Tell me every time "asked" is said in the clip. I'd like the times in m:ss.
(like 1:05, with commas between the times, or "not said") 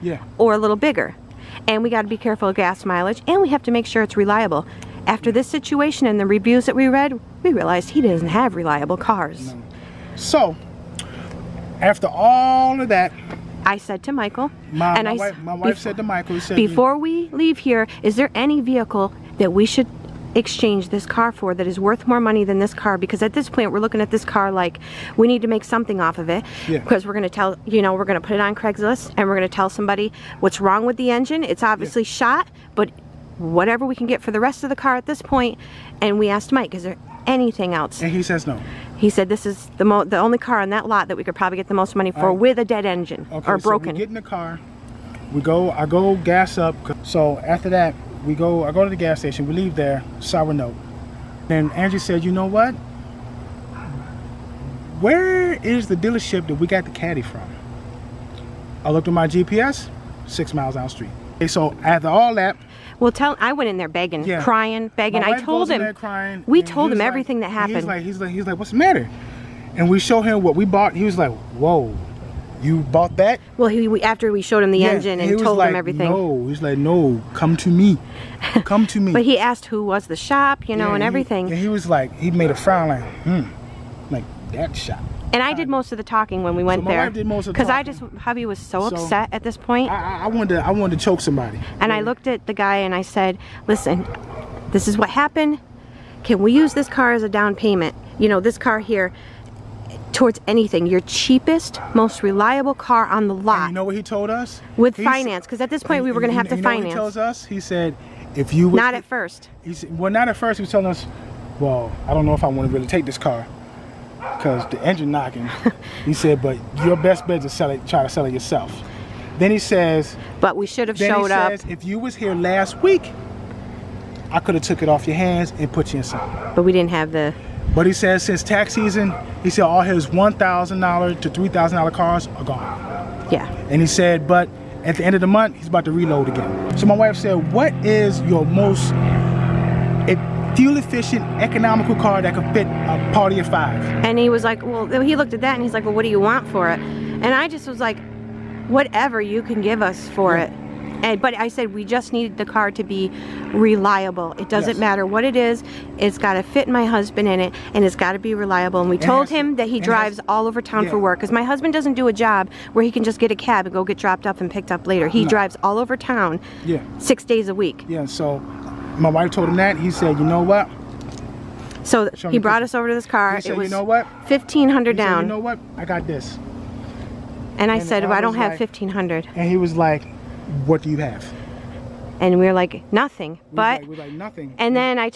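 0:36, 1:19.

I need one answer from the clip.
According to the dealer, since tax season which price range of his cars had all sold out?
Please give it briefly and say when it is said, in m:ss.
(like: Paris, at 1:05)
$1,000 to $3,000, at 2:10.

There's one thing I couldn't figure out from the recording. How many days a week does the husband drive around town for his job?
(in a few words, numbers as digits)
6.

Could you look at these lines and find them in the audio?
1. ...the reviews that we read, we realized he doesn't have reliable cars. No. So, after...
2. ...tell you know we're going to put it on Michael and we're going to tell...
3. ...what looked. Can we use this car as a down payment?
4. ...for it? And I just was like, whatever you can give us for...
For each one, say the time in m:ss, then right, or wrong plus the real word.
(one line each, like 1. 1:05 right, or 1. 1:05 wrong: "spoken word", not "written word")
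1. 0:06 right
2. 0:27 wrong: "Craigslist", not "Michael"
3. 1:34 wrong: "happened", not "looked"
4. 2:26 right.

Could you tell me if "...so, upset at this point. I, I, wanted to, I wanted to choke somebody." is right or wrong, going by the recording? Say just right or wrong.
right.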